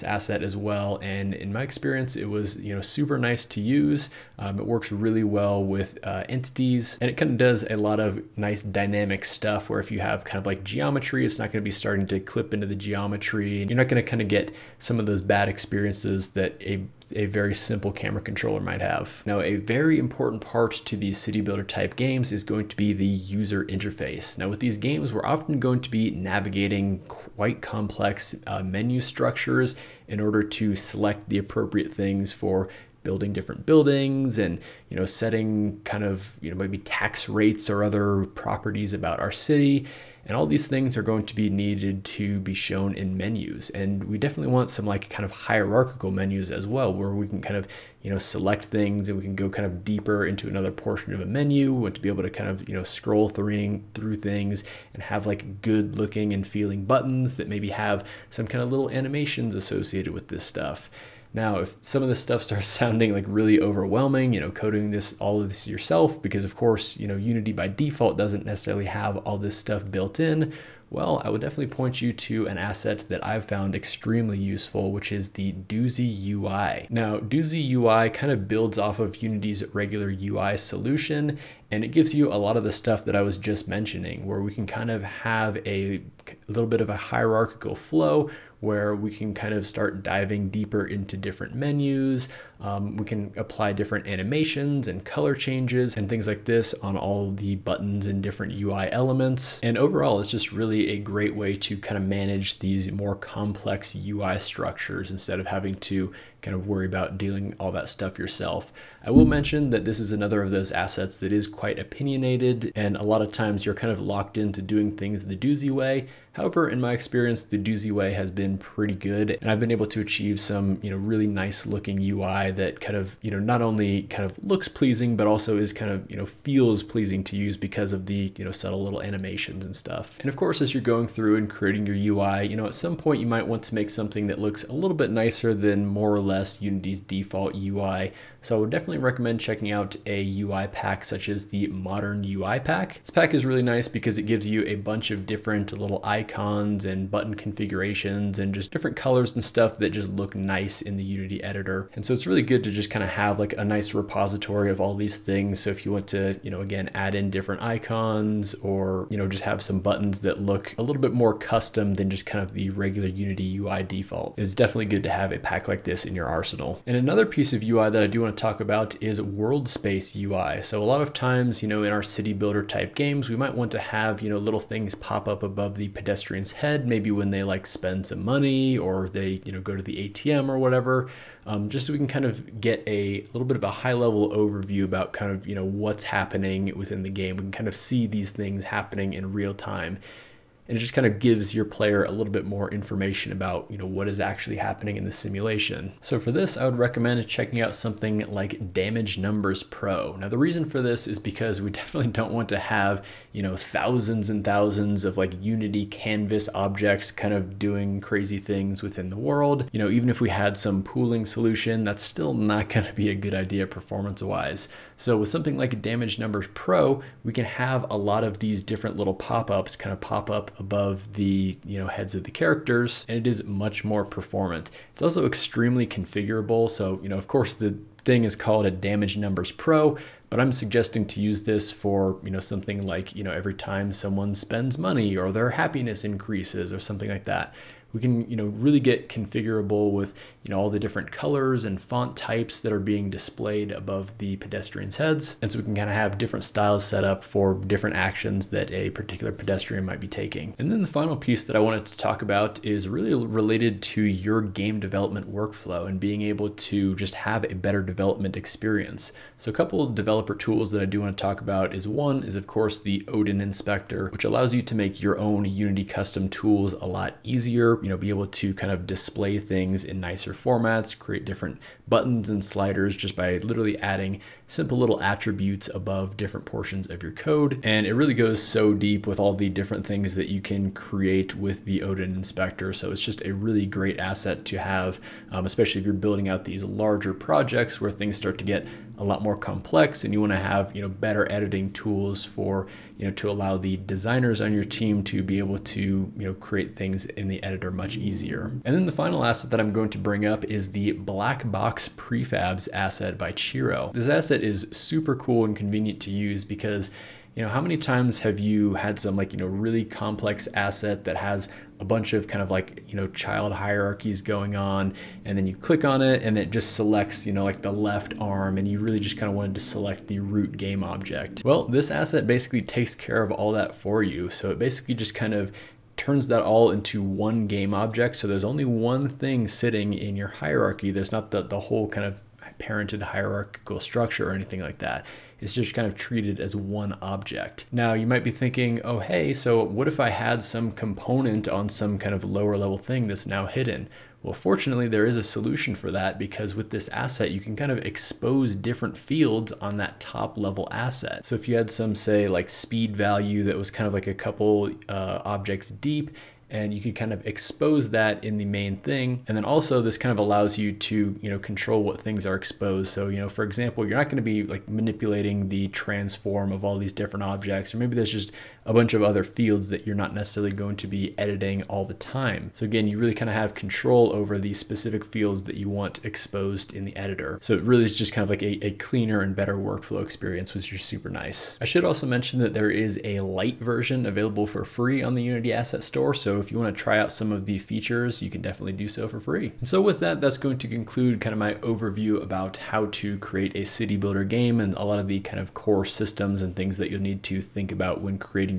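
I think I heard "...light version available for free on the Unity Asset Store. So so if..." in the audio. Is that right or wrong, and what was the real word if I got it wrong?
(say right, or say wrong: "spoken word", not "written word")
right.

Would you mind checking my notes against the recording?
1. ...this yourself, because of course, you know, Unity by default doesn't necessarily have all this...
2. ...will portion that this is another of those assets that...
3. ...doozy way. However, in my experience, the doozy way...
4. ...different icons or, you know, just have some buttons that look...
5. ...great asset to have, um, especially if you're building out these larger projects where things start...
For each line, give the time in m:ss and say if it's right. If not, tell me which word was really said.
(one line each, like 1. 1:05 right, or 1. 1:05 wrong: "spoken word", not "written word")
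1. 1:05 right
2. 1:49 wrong: "mention", not "portion"
3. 1:55 right
4. 2:37 right
5. 4:43 right.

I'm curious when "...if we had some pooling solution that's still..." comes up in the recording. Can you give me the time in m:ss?
3:30.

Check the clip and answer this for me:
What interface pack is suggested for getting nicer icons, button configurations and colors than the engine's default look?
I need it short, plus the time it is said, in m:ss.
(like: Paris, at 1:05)
Modern UI pack, at 2:21.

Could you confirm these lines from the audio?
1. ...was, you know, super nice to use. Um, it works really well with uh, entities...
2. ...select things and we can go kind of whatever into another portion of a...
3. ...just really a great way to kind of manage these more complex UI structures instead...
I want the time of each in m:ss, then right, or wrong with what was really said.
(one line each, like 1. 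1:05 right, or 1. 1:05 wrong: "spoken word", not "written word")
1. 0:02 right
2. 0:48 wrong: "deeper", not "whatever"
3. 1:40 right.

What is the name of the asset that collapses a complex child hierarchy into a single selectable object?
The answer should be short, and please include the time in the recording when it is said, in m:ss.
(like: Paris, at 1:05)
Black Box Prefabs, at 5:00.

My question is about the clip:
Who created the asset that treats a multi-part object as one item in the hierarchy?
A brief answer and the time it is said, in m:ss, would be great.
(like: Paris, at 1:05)
Chiro, at 5:03.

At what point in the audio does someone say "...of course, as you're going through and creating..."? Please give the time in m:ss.
2:10.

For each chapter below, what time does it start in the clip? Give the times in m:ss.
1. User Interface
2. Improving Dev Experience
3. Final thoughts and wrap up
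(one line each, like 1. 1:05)
1. 0:19
2. 4:09
3. 6:28.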